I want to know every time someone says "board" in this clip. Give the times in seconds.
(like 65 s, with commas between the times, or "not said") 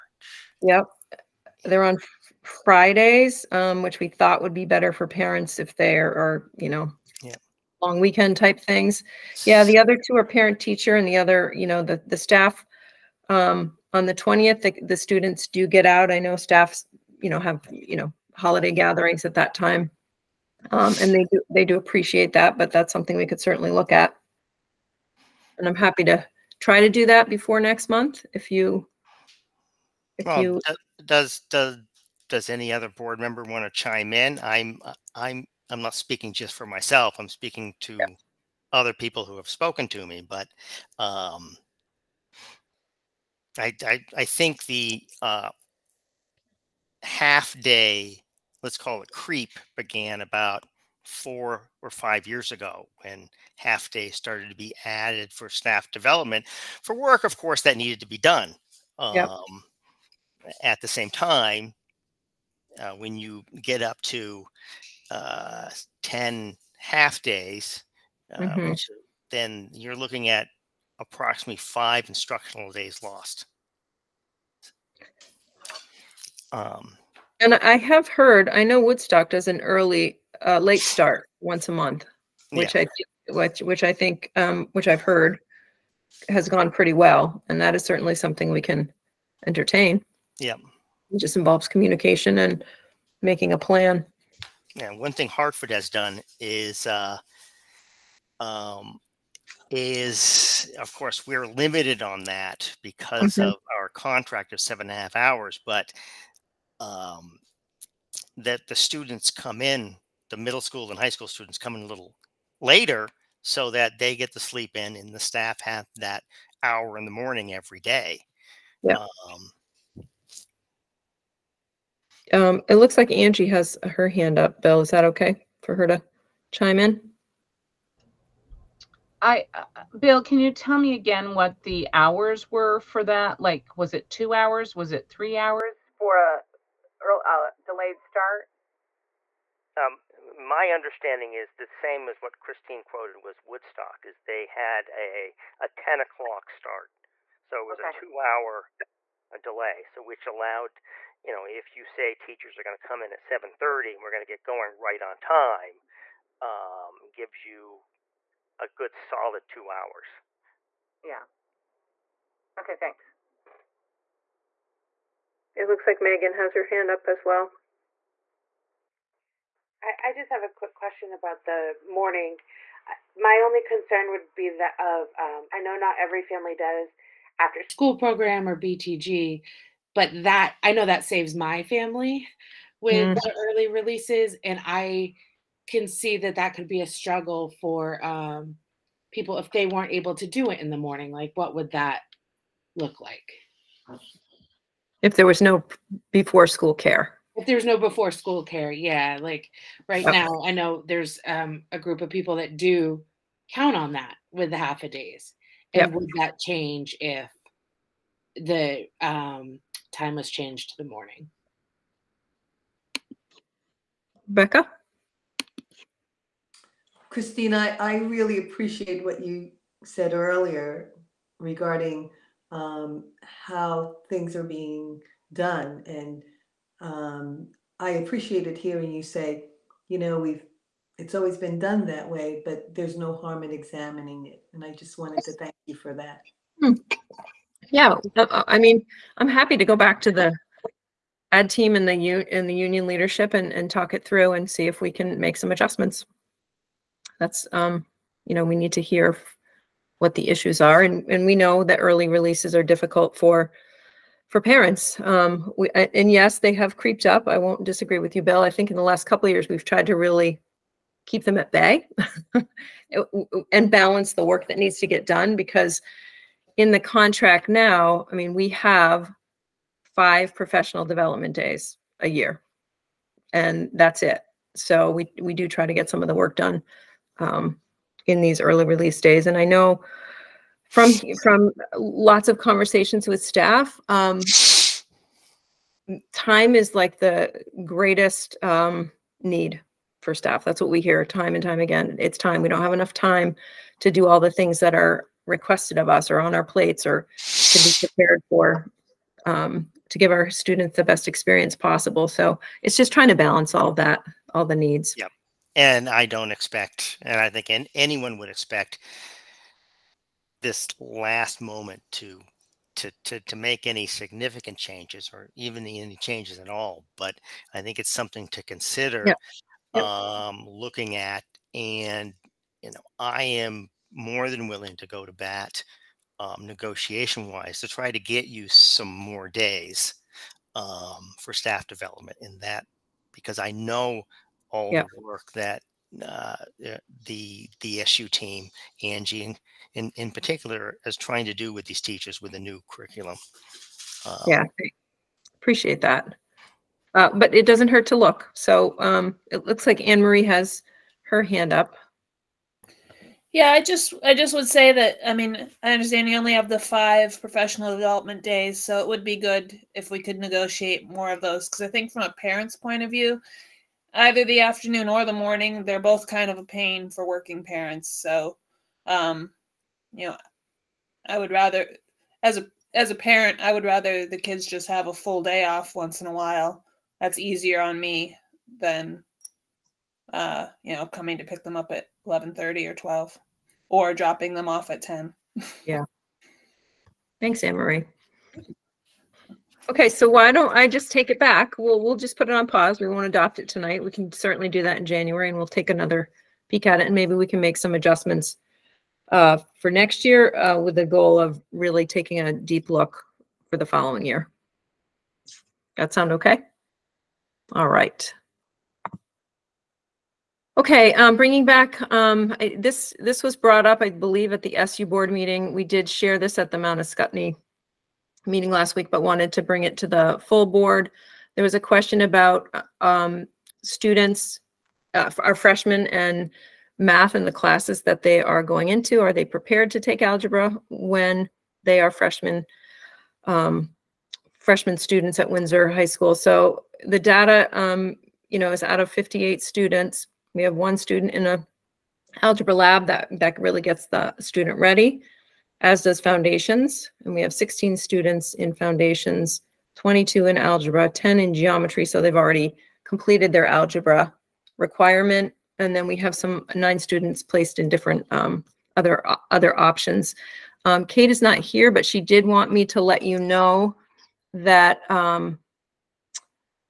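32 s, 414 s, 420 s.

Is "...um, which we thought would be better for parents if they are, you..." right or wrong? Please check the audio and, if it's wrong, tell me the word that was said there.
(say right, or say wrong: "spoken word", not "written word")
right.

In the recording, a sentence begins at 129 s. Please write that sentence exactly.
I, uh, Bill, can you tell me again what the hours were for that?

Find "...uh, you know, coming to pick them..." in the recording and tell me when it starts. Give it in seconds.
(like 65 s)
380 s.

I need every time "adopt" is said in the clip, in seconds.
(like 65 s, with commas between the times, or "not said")
393 s.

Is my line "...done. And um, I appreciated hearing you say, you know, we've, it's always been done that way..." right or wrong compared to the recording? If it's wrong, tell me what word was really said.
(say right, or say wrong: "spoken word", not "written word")
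right.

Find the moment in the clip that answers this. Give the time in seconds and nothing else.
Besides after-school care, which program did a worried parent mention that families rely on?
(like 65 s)
178 s.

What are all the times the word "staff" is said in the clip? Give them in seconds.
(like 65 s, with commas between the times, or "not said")
12 s, 16 s, 55 s, 115 s, 283 s, 290 s, 331 s.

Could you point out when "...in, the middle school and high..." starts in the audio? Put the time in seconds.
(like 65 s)
109 s.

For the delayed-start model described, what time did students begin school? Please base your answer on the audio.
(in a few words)
10 o'clock.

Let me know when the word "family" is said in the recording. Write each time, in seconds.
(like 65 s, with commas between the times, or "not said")
176 s, 181 s.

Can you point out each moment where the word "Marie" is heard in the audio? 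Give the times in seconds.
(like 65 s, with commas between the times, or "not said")
350 s, 387 s.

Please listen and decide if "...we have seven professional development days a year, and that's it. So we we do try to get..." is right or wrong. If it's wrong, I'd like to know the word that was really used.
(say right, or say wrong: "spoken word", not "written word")
wrong: "five", not "seven".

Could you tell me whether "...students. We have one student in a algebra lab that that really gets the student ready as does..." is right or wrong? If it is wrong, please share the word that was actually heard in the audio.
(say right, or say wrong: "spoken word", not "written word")
right.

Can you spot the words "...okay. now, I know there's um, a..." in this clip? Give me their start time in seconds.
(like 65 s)
200 s.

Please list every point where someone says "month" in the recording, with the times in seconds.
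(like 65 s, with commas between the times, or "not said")
27 s, 81 s.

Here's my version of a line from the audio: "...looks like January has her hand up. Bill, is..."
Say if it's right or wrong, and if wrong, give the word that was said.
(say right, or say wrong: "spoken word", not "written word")
wrong: "Angie", not "January".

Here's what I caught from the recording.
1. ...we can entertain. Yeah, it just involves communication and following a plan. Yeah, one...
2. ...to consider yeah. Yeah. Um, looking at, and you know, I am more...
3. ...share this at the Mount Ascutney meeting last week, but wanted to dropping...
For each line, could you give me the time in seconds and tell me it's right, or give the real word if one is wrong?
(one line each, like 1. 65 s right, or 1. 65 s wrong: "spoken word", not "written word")
1. 88 s wrong: "making", not "following"
2. 318 s right
3. 415 s wrong: "bring", not "dropping".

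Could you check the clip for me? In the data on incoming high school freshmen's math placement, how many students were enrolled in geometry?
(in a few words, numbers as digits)
10.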